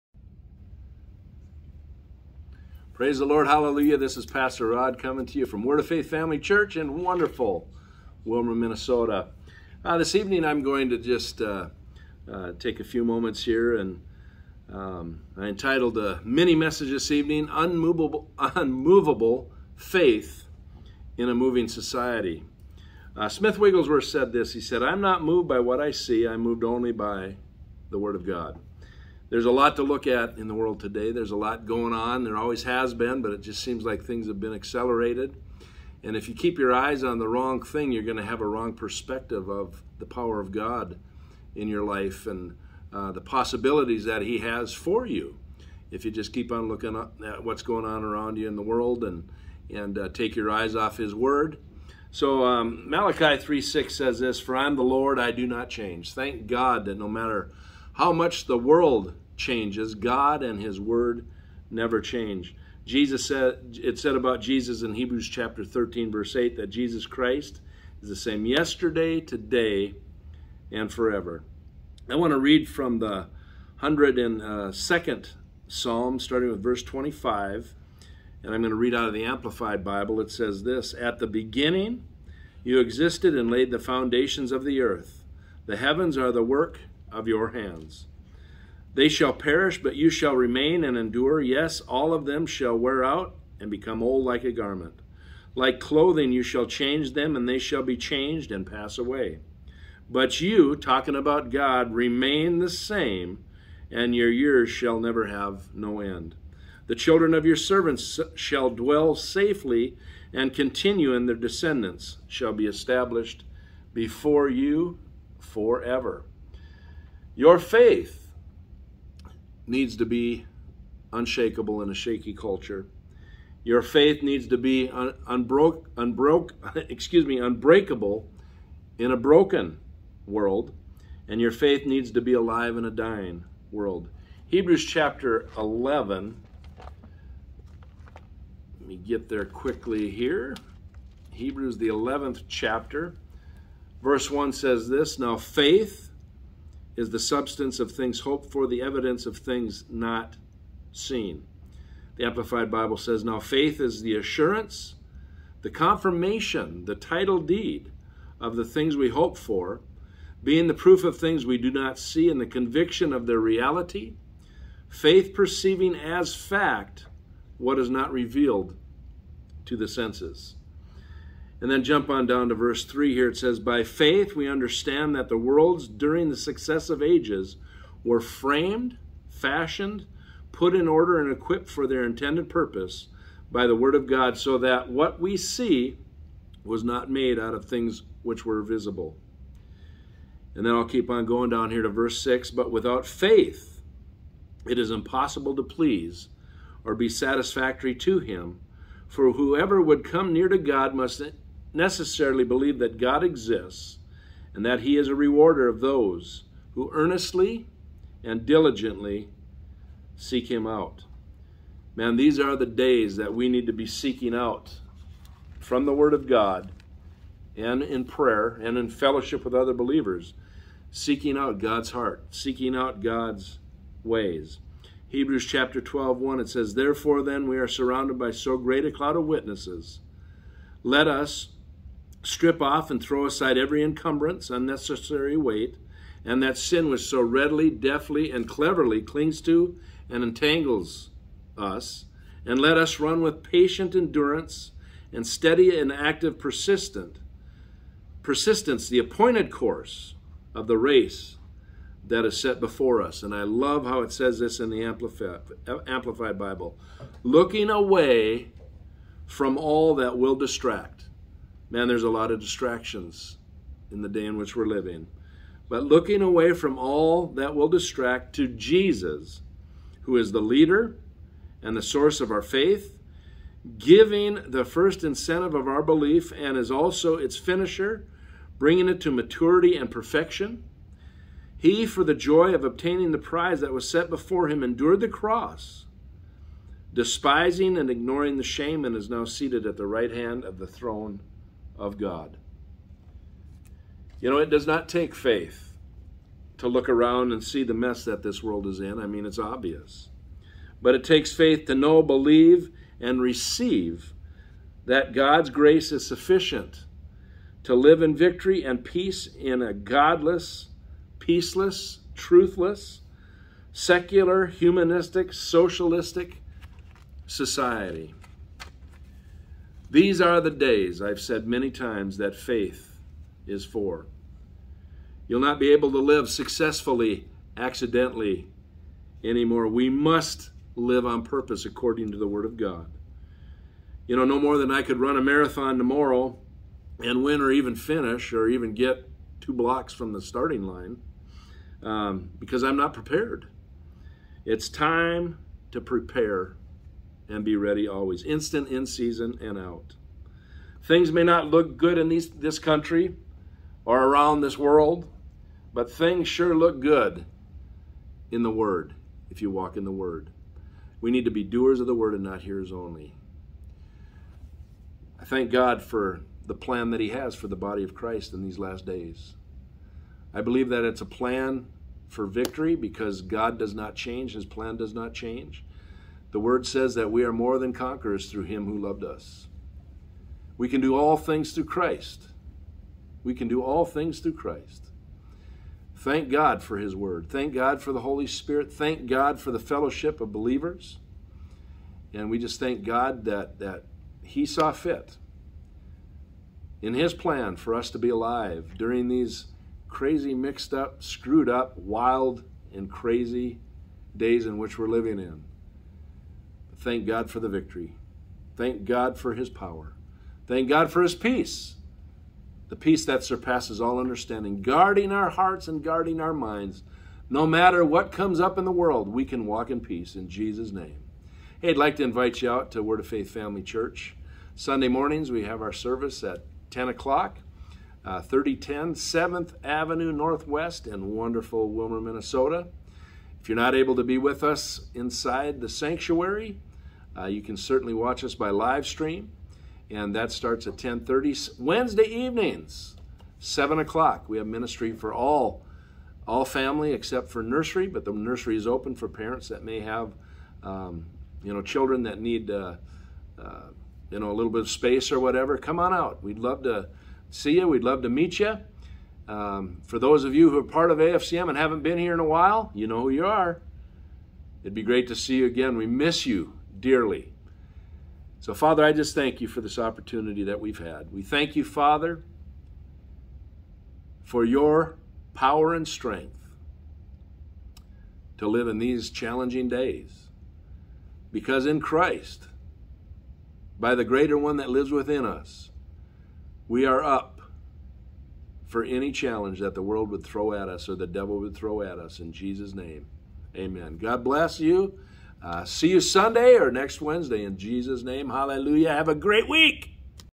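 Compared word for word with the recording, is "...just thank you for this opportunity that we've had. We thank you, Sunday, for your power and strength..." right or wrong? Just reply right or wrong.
wrong.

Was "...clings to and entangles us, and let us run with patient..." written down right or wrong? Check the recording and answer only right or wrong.
right.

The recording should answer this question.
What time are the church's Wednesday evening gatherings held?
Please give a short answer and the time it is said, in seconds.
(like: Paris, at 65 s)
7 o'clock, at 443 s.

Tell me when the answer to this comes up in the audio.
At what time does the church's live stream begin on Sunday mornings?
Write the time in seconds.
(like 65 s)
440 s.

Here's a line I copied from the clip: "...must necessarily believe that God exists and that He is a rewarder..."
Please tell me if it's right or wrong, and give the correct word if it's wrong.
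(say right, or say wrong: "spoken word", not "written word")
right.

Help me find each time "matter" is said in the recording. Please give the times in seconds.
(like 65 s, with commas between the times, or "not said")
57 s, 417 s.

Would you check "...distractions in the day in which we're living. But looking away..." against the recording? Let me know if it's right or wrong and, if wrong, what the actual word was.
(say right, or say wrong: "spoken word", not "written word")
right.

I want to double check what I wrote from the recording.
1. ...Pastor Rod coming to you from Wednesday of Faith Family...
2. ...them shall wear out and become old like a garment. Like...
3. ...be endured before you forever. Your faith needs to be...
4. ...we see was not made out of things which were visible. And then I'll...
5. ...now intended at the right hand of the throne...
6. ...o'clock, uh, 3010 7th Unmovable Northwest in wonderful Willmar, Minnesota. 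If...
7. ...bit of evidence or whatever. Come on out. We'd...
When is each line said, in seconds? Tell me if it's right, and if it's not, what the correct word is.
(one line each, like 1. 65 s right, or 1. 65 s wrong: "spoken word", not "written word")
1. 4 s wrong: "Word", not "Wednesday"
2. 92 s right
3. 112 s wrong: "established", not "endured"
4. 185 s right
5. 289 s wrong: "seated", not "intended"
6. 426 s wrong: "Avenue", not "Unmovable"
7. 454 s wrong: "space", not "evidence".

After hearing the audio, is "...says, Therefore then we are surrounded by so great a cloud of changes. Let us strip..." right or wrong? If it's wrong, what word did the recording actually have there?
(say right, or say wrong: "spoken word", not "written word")
wrong: "witnesses", not "changes".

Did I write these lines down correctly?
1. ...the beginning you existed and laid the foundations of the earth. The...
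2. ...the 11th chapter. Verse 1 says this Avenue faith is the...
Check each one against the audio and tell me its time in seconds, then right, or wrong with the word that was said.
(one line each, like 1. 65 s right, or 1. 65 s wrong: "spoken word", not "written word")
1. 81 s right
2. 141 s wrong: "Now", not "Avenue".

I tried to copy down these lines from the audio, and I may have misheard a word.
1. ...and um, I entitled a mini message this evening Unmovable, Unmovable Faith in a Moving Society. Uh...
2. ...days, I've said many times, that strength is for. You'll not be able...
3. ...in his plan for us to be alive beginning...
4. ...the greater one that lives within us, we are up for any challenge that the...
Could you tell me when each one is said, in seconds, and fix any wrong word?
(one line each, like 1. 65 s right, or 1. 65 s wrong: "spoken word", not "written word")
1. 13 s right
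2. 320 s wrong: "faith", not "strength"
3. 396 s wrong: "during", not "beginning"
4. 483 s right.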